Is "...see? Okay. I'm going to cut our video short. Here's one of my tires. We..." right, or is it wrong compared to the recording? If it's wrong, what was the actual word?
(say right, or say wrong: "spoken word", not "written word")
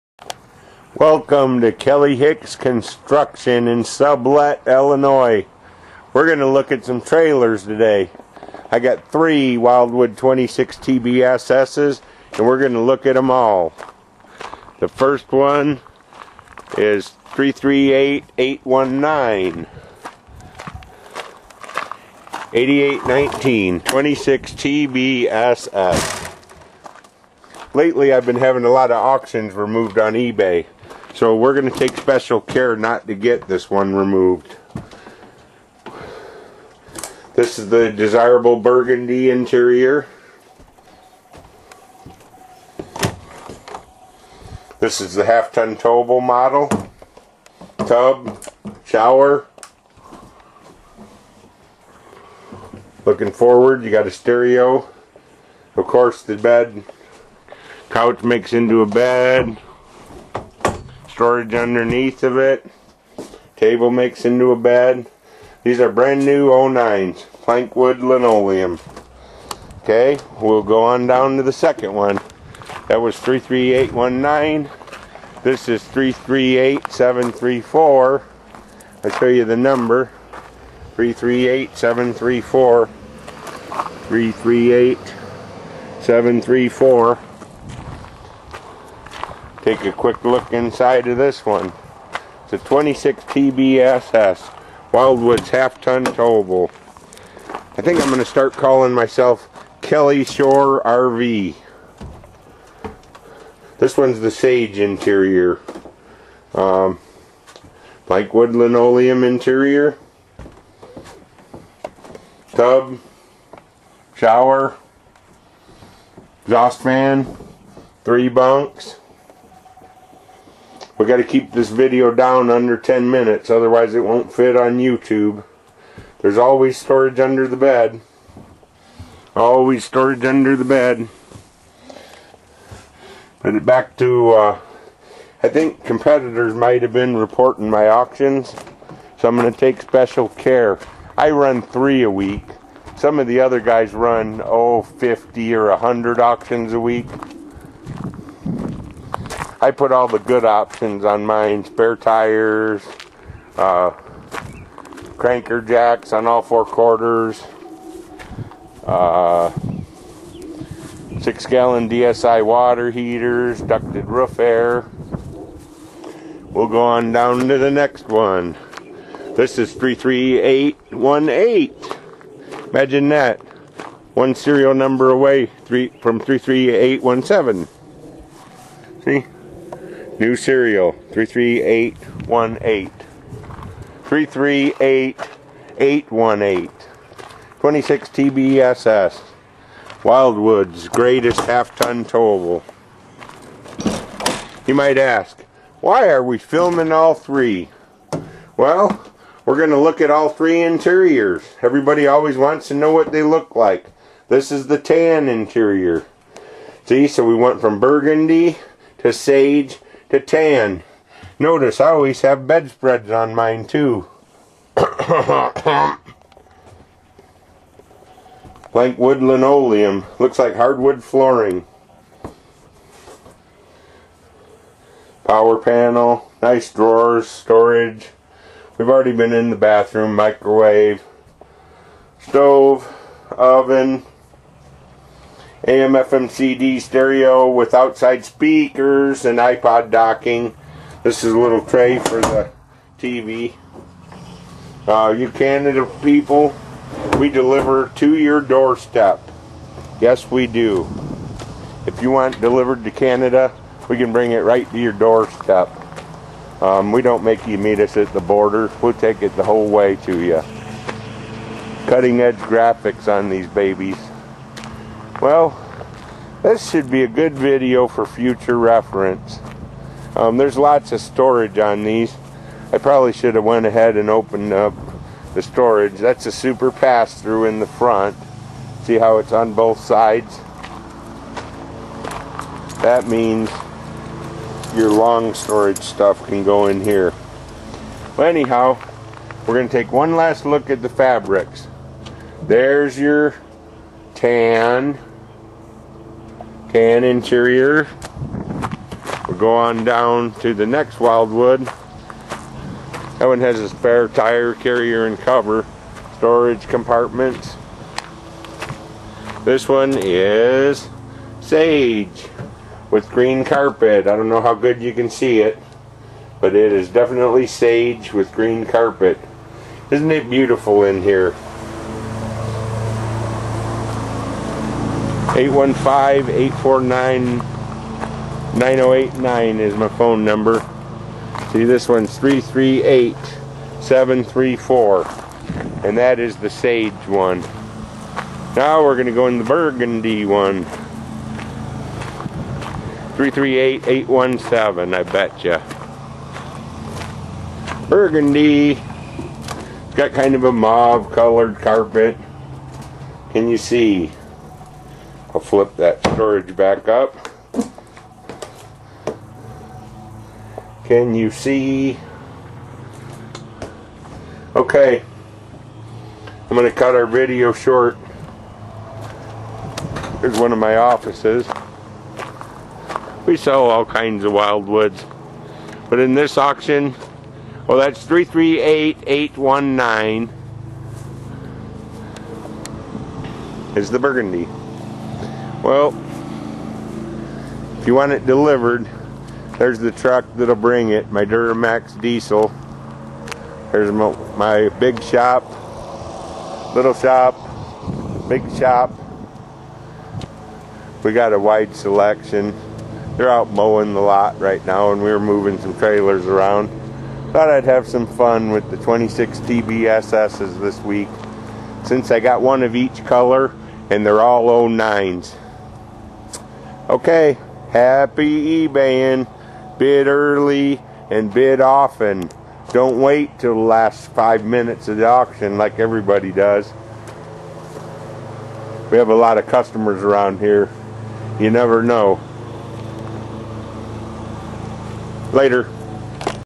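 wrong: "offices", not "tires".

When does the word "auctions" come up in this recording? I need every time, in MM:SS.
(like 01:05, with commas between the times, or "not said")
00:28, 02:17, 02:26, 06:16, 07:05.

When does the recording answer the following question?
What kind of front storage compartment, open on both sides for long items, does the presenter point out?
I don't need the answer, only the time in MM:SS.
04:36.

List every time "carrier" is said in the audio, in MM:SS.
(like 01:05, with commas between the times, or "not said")
05:04.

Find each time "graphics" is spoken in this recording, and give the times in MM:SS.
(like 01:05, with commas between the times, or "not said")
04:22.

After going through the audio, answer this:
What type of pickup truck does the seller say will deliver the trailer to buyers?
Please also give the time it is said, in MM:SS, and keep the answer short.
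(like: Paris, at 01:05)
Duramax diesel, at 06:31.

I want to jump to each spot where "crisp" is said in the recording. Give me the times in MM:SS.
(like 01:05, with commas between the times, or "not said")
not said.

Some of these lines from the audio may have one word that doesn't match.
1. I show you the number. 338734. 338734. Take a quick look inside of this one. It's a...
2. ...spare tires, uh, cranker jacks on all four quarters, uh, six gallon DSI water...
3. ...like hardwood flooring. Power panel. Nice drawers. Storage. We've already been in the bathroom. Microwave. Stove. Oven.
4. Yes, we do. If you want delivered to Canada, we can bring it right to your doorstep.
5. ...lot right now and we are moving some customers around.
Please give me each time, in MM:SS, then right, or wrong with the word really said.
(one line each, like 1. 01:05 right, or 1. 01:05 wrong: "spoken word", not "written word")
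1. 01:19 right
2. 02:31 right
3. 03:40 right
4. 04:09 right
5. 06:44 wrong: "trailers", not "customers".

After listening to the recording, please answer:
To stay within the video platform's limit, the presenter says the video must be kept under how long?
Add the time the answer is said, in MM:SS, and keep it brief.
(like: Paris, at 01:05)
10 minutes, at 02:02.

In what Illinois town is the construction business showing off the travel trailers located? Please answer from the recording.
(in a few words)
Sublette.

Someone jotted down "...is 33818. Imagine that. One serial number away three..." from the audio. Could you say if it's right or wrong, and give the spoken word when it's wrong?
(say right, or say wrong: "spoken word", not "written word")
right.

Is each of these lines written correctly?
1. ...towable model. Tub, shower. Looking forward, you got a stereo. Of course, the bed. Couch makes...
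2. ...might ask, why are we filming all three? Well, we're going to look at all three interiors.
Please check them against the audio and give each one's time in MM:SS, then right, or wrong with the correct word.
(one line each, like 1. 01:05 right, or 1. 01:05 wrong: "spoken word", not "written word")
1. 00:45 right
2. 03:14 right.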